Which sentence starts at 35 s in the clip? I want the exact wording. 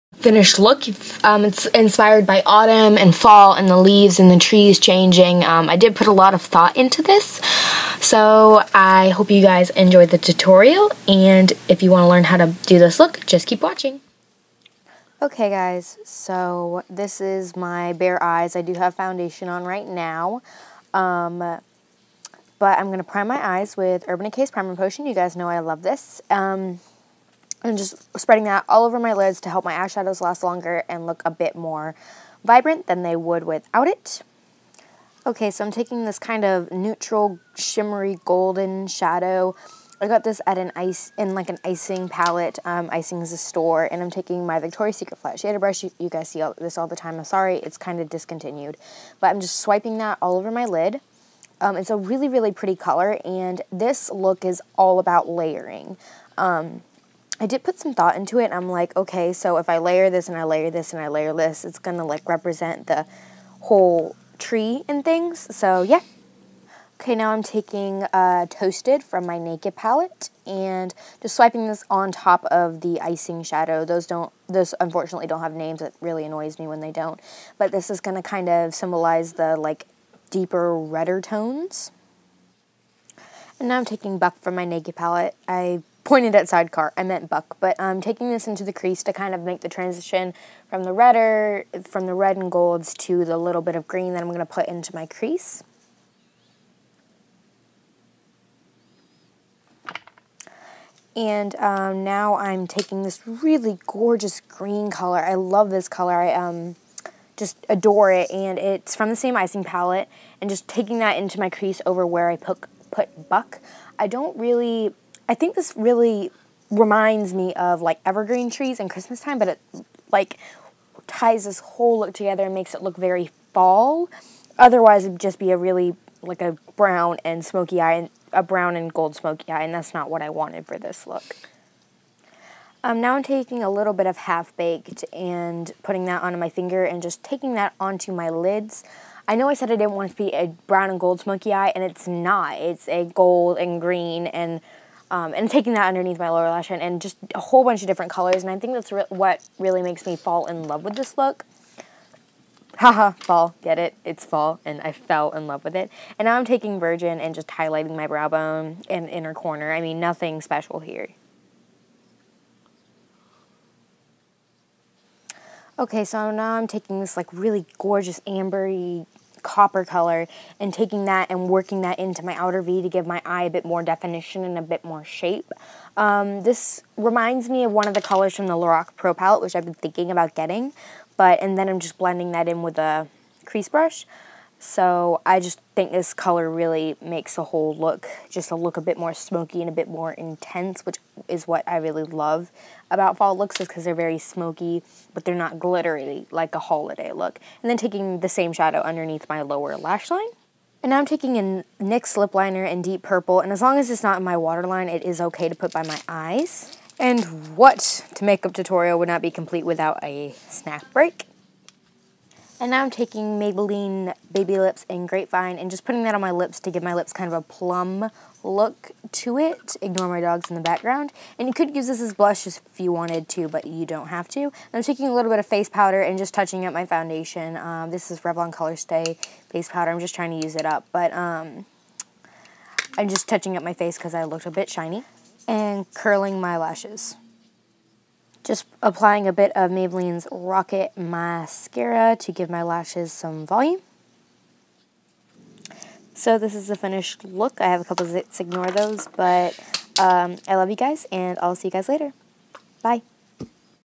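Okay, so I'm taking this kind of neutral, shimmery, golden shadow.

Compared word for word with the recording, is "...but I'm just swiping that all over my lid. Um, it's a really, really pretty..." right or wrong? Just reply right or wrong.
right.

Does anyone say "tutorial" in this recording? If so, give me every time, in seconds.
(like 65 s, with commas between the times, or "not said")
10 s, 208 s.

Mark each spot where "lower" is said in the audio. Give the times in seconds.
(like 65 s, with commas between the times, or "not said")
146 s, 199 s.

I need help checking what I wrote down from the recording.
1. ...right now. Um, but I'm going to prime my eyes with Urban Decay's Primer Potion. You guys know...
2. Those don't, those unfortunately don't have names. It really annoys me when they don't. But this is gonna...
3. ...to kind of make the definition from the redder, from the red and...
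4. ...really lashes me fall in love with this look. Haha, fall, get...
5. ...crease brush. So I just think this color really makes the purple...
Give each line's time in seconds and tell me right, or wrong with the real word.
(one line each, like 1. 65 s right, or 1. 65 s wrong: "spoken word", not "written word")
1. 19 s right
2. 73 s right
3. 89 s wrong: "transition", not "definition"
4. 149 s wrong: "makes", not "lashes"
5. 183 s wrong: "whole", not "purple".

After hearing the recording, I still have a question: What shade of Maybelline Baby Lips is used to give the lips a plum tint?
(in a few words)
Grapevine.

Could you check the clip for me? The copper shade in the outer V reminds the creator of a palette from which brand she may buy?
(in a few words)
Lorac.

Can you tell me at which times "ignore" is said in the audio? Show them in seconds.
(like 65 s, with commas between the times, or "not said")
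219 s, 248 s.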